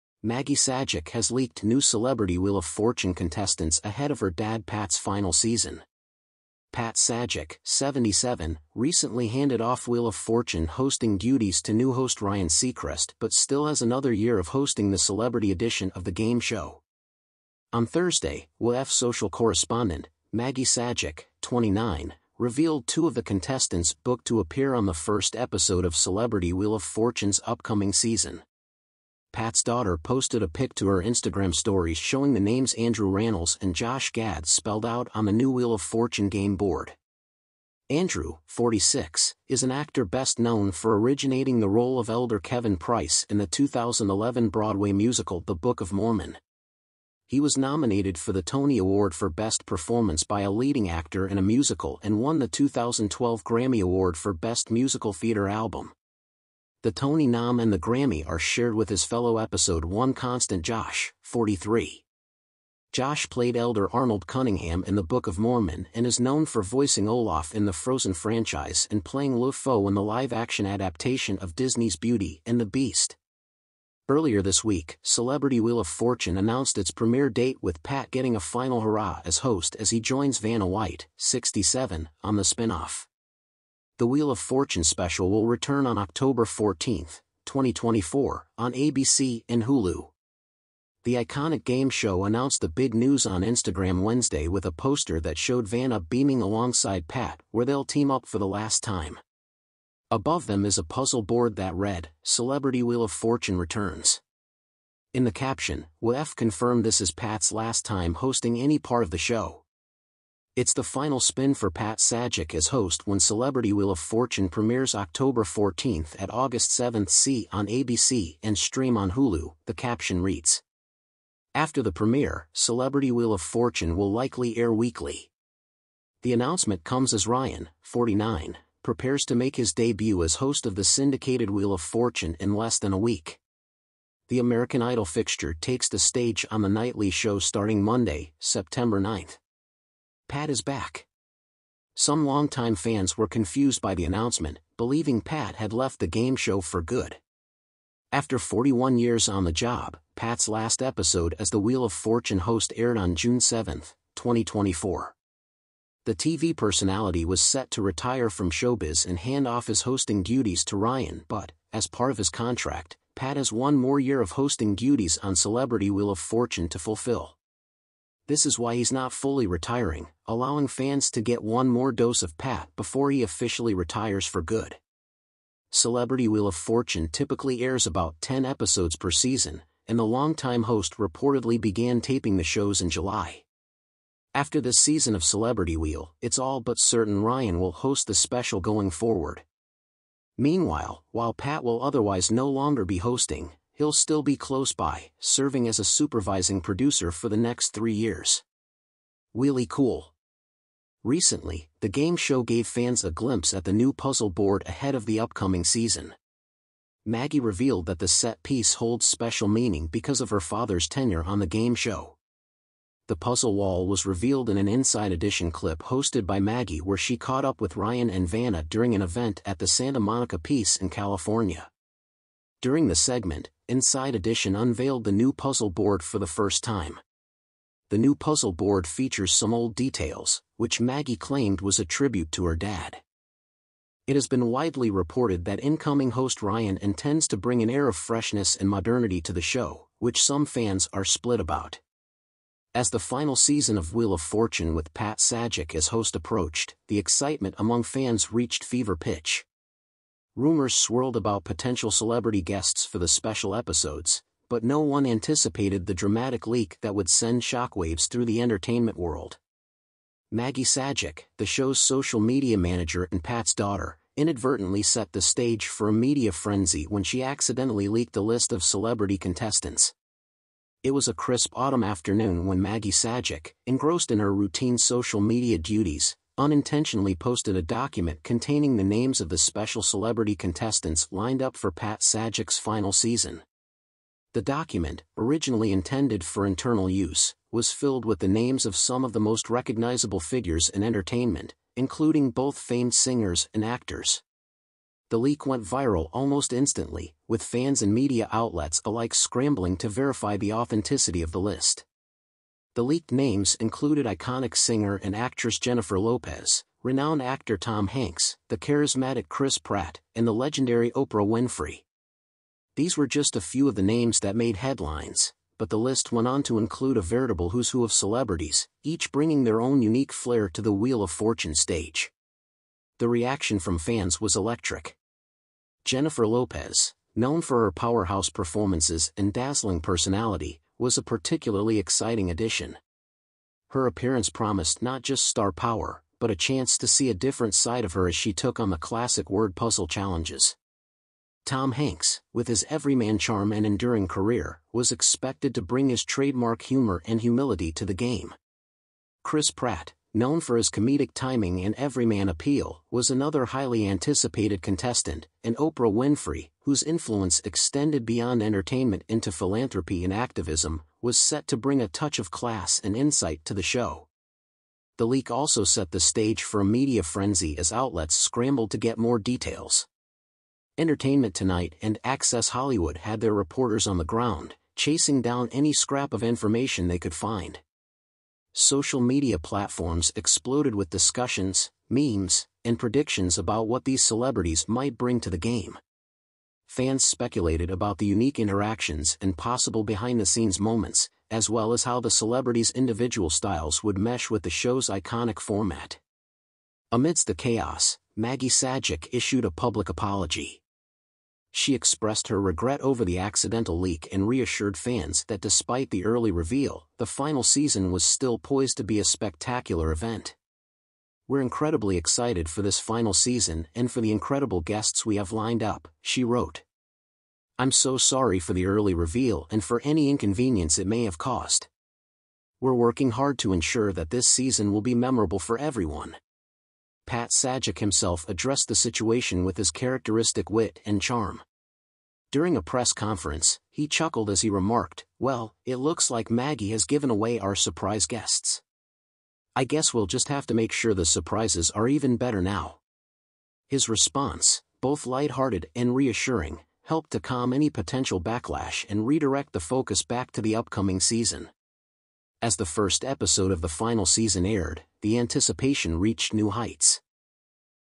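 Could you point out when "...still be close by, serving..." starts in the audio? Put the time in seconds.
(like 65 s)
193 s.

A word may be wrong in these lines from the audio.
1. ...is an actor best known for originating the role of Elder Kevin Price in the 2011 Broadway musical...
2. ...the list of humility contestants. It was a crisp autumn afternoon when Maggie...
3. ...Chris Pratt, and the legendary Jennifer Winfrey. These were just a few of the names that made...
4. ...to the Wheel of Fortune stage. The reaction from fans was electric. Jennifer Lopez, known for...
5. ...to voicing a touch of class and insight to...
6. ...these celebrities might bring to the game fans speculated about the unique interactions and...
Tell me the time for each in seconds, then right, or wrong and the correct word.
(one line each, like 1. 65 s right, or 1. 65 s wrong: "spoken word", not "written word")
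1. 39 s right
2. 268 s wrong: "celebrity", not "humility"
3. 309 s wrong: "Oprah", not "Jennifer"
4. 320 s right
5. 361 s wrong: "bring", not "voicing"
6. 383 s right.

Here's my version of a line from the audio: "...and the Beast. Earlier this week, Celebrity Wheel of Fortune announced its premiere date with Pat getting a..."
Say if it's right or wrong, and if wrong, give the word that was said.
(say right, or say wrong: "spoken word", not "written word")
right.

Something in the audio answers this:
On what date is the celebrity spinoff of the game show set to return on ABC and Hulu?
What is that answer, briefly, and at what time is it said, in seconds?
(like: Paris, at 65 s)
October 14, 2024, at 85 s.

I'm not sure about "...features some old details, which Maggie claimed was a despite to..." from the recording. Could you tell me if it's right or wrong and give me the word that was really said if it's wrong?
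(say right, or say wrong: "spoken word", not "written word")
wrong: "tribute", not "despite".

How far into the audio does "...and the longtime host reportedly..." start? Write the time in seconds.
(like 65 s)
179 s.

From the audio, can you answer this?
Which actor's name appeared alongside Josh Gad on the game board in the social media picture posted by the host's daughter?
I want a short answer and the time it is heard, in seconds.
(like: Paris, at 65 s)
Andrew Rannells, at 32 s.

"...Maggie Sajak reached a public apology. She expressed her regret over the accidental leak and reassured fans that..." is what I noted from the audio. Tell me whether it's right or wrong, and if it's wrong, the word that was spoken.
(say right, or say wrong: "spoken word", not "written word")
wrong: "issued", not "reached".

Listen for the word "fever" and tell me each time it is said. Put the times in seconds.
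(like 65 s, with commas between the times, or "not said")
248 s.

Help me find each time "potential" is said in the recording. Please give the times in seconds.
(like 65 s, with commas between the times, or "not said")
251 s, 447 s.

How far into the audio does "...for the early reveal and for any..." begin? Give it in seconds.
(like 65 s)
418 s.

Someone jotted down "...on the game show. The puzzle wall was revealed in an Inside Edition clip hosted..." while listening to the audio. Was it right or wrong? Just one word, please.
right.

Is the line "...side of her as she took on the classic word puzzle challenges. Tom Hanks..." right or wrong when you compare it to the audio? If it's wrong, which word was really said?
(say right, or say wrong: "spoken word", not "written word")
right.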